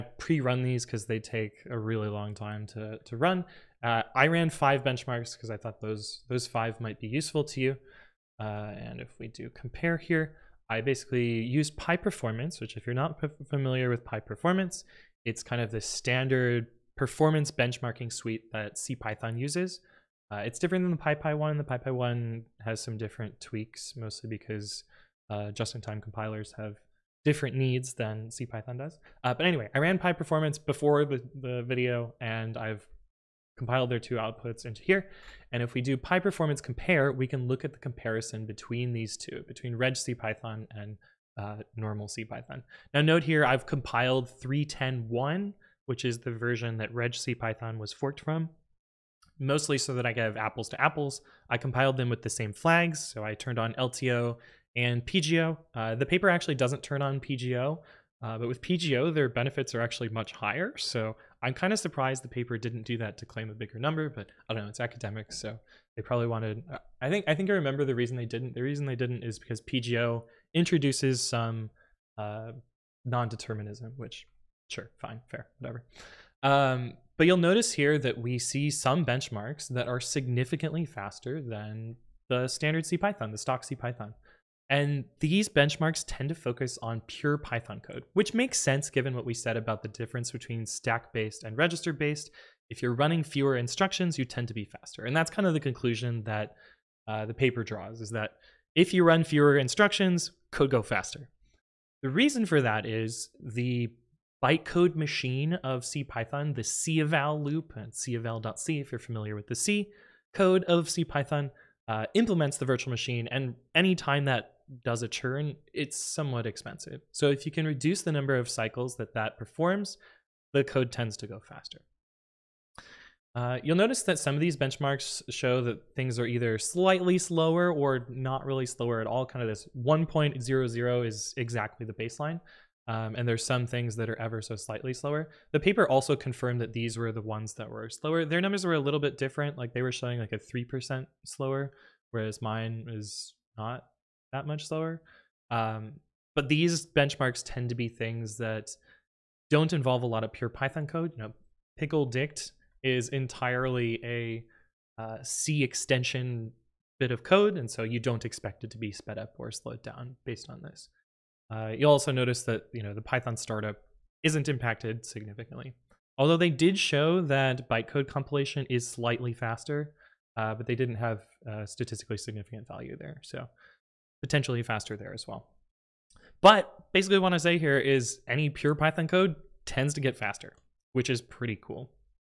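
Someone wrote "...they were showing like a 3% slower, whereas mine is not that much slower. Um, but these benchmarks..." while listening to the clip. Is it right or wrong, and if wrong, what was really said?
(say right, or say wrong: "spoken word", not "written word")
right.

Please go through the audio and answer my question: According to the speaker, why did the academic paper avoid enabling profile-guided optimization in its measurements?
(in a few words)
Non-determinism.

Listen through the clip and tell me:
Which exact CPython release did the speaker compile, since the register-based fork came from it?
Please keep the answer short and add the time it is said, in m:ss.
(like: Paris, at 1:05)
3.10.1, at 0:44.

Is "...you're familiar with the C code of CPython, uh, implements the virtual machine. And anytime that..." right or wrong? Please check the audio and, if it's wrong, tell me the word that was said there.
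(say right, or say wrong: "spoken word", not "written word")
right.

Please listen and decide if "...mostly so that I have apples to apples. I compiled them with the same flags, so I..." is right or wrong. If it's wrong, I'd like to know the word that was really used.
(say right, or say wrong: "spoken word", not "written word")
right.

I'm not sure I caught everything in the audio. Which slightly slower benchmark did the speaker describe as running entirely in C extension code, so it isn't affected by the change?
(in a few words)
pickle dict.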